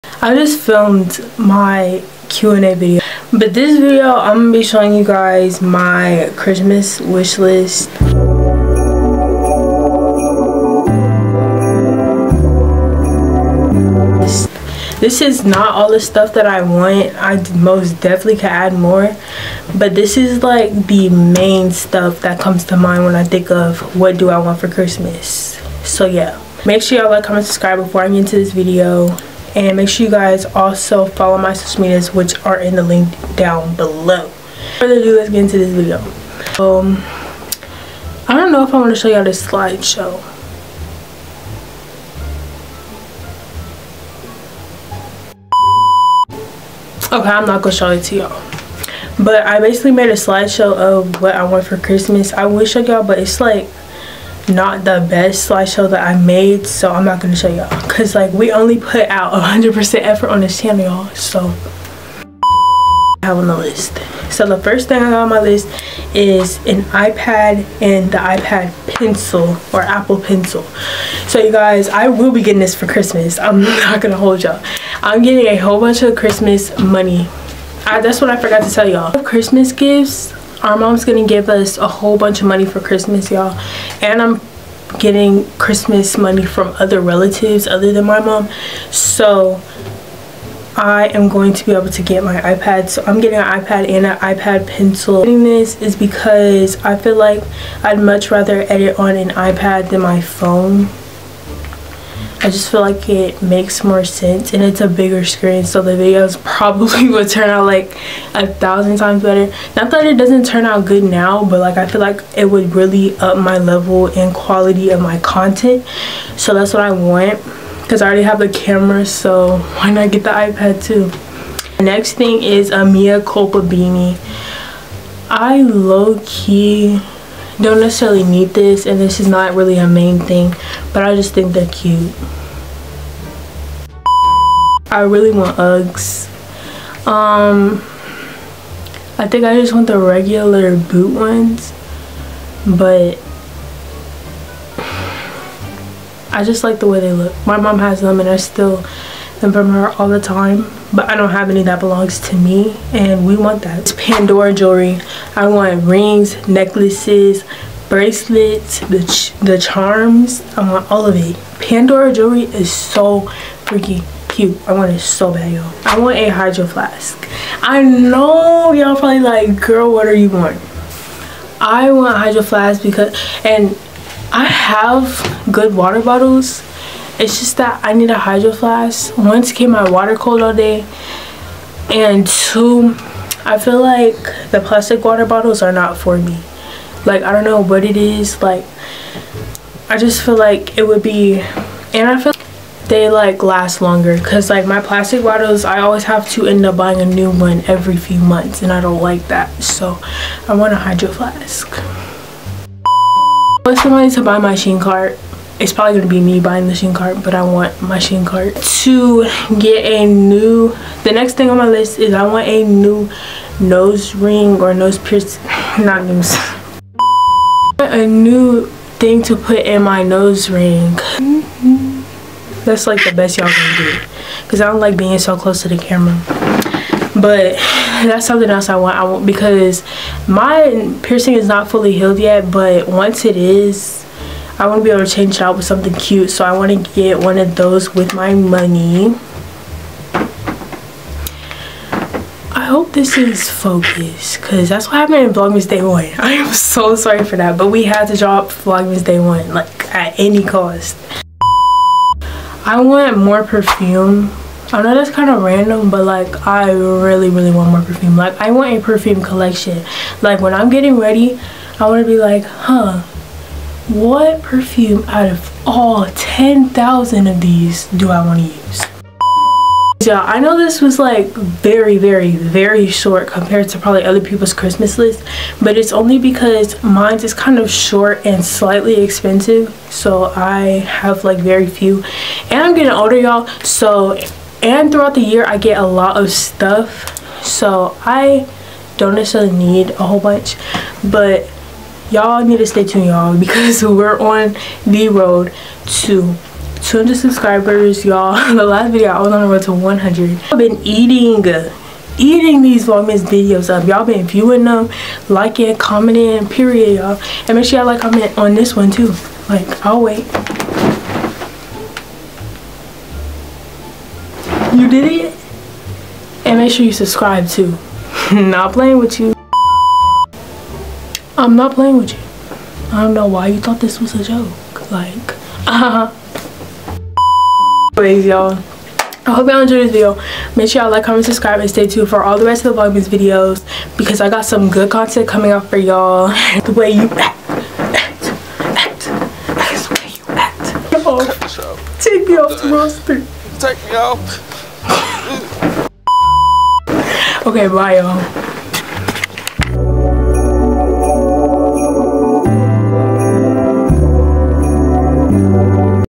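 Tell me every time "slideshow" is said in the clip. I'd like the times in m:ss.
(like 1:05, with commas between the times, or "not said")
0:39, 0:50, 0:55.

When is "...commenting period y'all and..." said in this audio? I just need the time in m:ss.
5:05.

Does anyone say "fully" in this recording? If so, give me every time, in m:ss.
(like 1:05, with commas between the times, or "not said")
3:51.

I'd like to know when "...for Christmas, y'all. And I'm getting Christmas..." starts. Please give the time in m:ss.
1:22.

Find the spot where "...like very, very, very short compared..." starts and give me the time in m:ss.
4:30.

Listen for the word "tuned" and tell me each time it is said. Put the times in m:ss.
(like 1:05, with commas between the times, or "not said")
4:52, 5:31.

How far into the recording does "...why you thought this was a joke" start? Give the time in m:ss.
5:23.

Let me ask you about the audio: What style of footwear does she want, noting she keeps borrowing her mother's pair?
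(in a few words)
Uggs.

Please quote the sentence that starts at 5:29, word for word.
I hope y'all enjoyed this video.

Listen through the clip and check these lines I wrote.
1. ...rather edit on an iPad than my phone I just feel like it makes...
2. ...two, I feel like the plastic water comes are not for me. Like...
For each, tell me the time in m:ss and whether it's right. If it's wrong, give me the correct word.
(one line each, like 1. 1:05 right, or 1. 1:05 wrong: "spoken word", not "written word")
1. 1:38 right
2. 3:02 wrong: "bottles", not "comes".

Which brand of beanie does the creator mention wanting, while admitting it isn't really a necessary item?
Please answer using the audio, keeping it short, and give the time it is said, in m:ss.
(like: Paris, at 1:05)
Mea Culpa, at 2:02.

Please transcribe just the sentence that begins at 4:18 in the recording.
Like I want a perfume collection.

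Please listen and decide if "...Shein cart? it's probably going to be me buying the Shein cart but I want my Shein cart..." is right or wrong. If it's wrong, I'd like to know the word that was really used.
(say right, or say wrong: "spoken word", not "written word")
right.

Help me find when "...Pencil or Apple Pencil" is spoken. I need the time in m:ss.
1:08.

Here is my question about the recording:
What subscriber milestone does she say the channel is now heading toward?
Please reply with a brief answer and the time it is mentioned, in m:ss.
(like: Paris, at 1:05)
200 subscribers, at 4:56.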